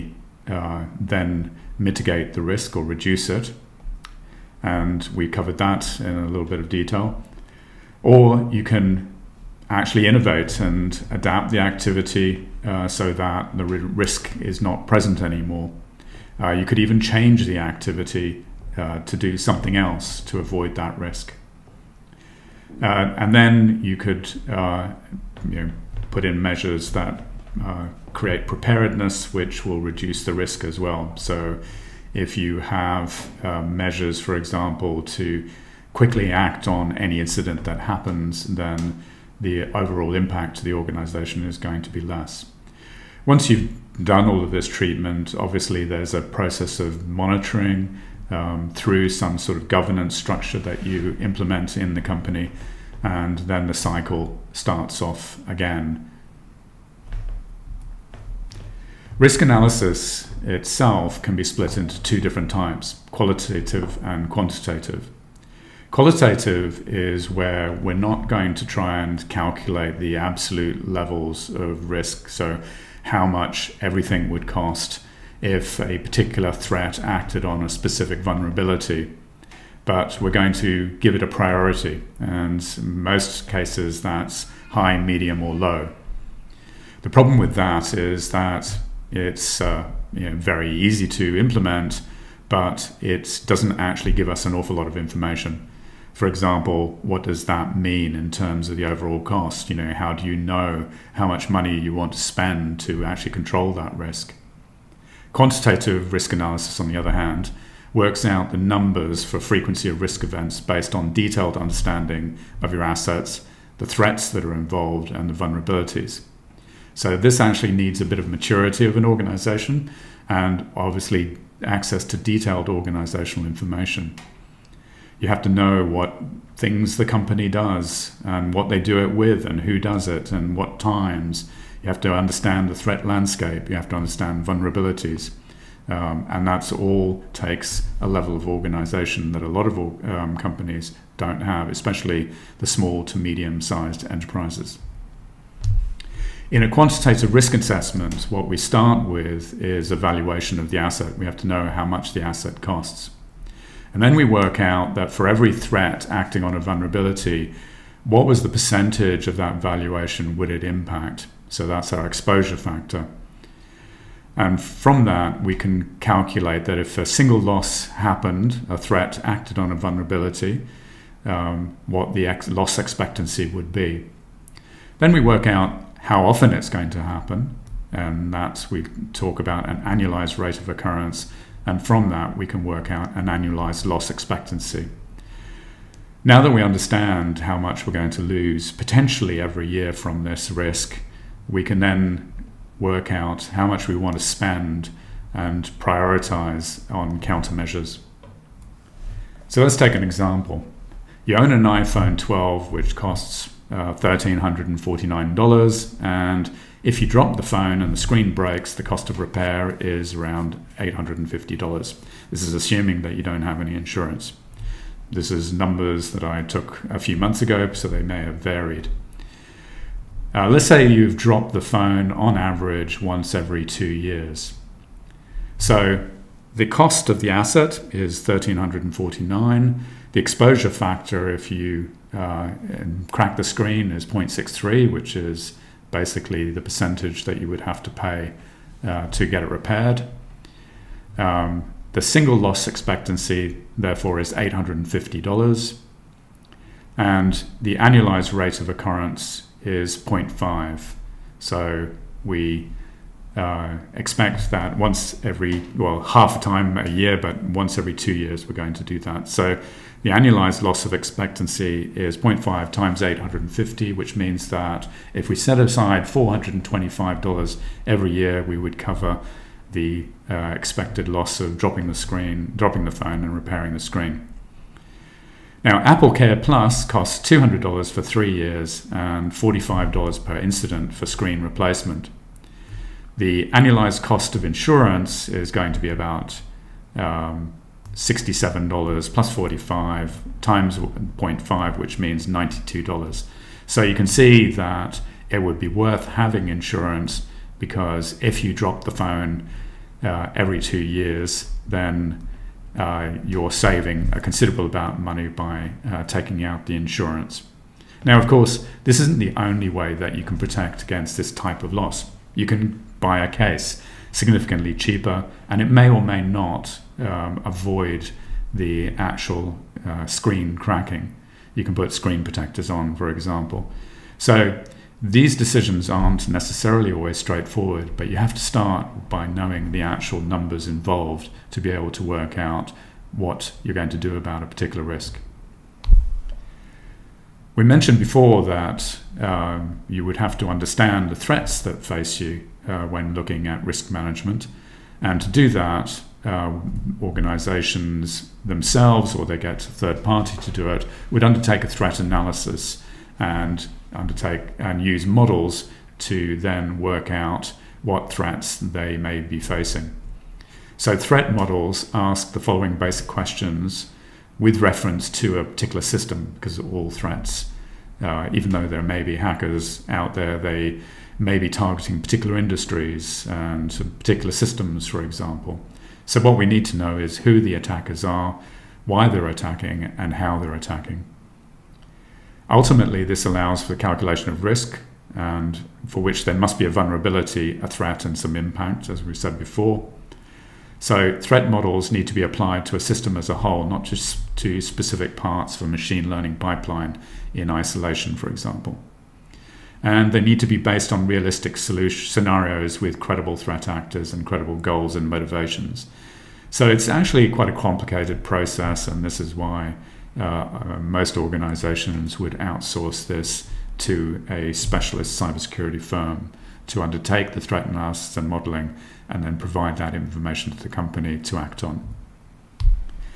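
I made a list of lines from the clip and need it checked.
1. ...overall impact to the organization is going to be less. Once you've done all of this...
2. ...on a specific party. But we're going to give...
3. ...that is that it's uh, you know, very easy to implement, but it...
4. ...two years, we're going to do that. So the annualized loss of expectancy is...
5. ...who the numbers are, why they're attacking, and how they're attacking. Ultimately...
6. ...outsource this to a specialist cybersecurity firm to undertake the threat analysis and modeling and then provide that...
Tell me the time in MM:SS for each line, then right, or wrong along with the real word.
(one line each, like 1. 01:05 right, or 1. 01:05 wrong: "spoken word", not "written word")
1. 00:39 right
2. 01:17 wrong: "vulnerability", not "party"
3. 01:27 right
4. 04:17 right
5. 06:17 wrong: "attackers", not "numbers"
6. 06:52 right.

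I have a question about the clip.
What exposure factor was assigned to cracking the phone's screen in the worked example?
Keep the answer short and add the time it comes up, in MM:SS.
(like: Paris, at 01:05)
0.63, at 03:54.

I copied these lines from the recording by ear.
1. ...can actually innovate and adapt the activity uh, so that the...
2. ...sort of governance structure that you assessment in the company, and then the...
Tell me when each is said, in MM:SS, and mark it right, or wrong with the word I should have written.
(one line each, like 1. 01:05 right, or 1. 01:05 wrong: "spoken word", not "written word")
1. 00:08 right
2. 00:49 wrong: "implement", not "assessment".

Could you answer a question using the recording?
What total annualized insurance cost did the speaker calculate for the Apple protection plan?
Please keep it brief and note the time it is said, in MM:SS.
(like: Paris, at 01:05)
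$92, at 04:52.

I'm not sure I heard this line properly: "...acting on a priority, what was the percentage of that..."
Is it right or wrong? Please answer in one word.
wrong.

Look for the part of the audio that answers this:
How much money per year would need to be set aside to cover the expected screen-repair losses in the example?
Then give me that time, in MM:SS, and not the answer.
04:26.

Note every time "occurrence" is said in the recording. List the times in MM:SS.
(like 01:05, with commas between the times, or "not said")
03:00, 04:08.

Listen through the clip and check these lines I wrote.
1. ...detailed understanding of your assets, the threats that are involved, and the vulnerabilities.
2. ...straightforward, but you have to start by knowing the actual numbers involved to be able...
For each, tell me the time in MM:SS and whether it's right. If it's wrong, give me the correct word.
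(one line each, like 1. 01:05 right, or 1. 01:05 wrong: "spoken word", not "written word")
1. 01:51 right
2. 05:27 right.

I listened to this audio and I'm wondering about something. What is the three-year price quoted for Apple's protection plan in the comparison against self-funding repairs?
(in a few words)
$200.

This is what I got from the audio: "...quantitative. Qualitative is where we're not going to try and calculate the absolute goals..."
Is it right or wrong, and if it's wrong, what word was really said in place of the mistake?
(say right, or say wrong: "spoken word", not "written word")
wrong: "levels", not "goals".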